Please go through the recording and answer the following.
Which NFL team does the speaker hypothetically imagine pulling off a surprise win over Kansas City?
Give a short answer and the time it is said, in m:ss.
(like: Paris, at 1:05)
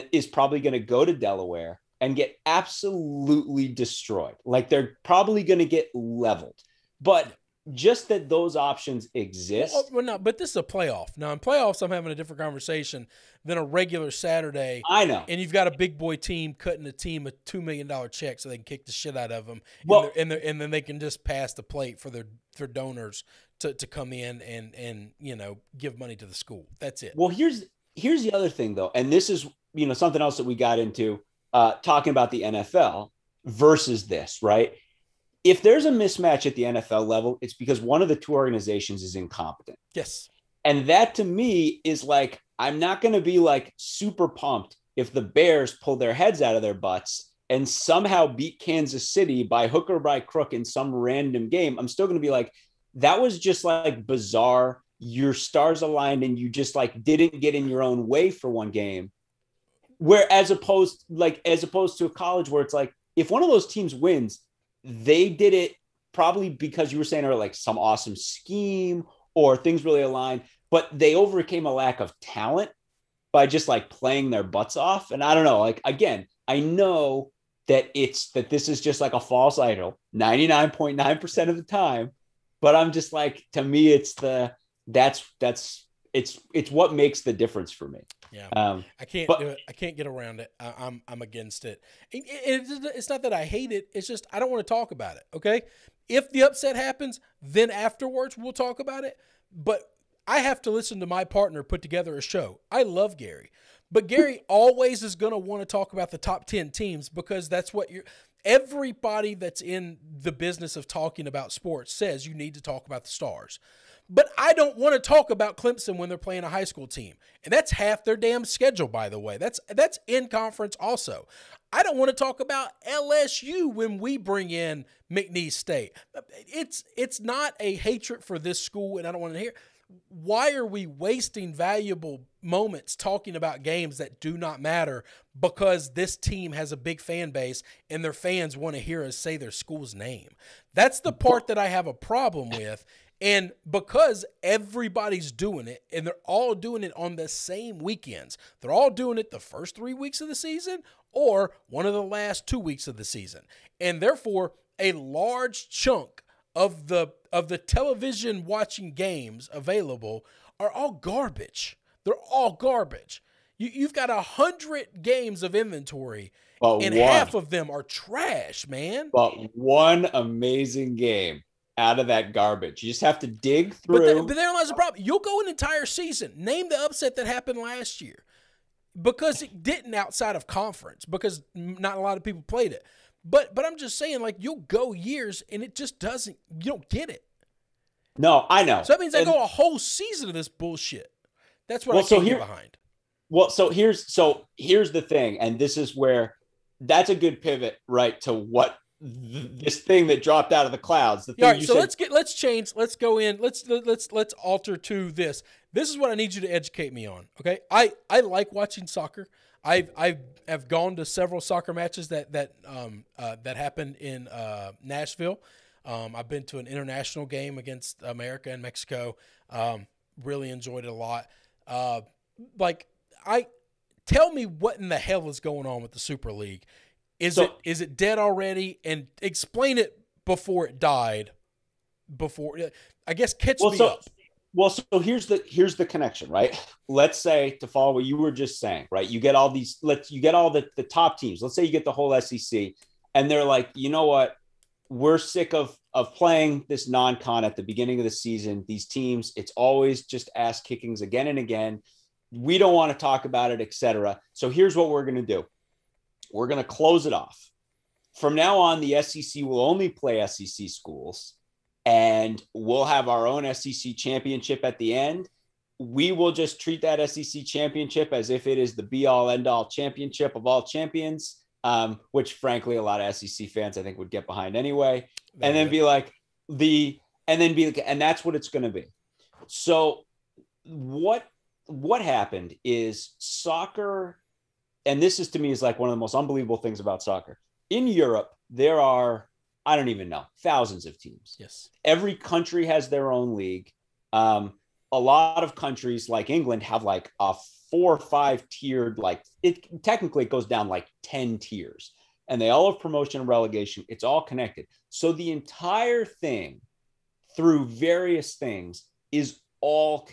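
The Bears, at 0:45.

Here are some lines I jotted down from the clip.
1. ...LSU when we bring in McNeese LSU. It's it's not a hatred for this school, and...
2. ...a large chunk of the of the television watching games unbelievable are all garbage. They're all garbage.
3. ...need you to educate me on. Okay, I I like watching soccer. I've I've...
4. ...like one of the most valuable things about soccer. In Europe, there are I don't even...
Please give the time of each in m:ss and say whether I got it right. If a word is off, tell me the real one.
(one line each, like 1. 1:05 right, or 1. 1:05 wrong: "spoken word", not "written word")
1. 2:02 wrong: "State", not "LSU"
2. 2:34 wrong: "available", not "unbelievable"
3. 3:26 right
4. 4:45 wrong: "unbelievable", not "valuable".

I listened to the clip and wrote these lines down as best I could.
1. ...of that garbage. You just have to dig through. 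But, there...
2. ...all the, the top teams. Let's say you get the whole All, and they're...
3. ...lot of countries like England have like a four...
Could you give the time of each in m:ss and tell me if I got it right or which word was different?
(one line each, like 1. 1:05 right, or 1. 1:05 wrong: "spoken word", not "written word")
1. 2:51 right
2. 4:00 wrong: "SEC", not "All"
3. 4:54 right.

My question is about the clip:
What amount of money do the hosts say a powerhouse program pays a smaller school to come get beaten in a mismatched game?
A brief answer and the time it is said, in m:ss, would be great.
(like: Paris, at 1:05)
$2 million, at 0:17.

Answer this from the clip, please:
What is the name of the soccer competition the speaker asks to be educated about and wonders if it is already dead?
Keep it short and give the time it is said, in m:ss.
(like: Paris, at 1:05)
Super League, at 3:45.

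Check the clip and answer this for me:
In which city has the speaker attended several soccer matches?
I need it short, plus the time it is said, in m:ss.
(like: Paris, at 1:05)
Nashville, at 3:34.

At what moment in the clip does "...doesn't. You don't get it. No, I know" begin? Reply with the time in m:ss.
3:05.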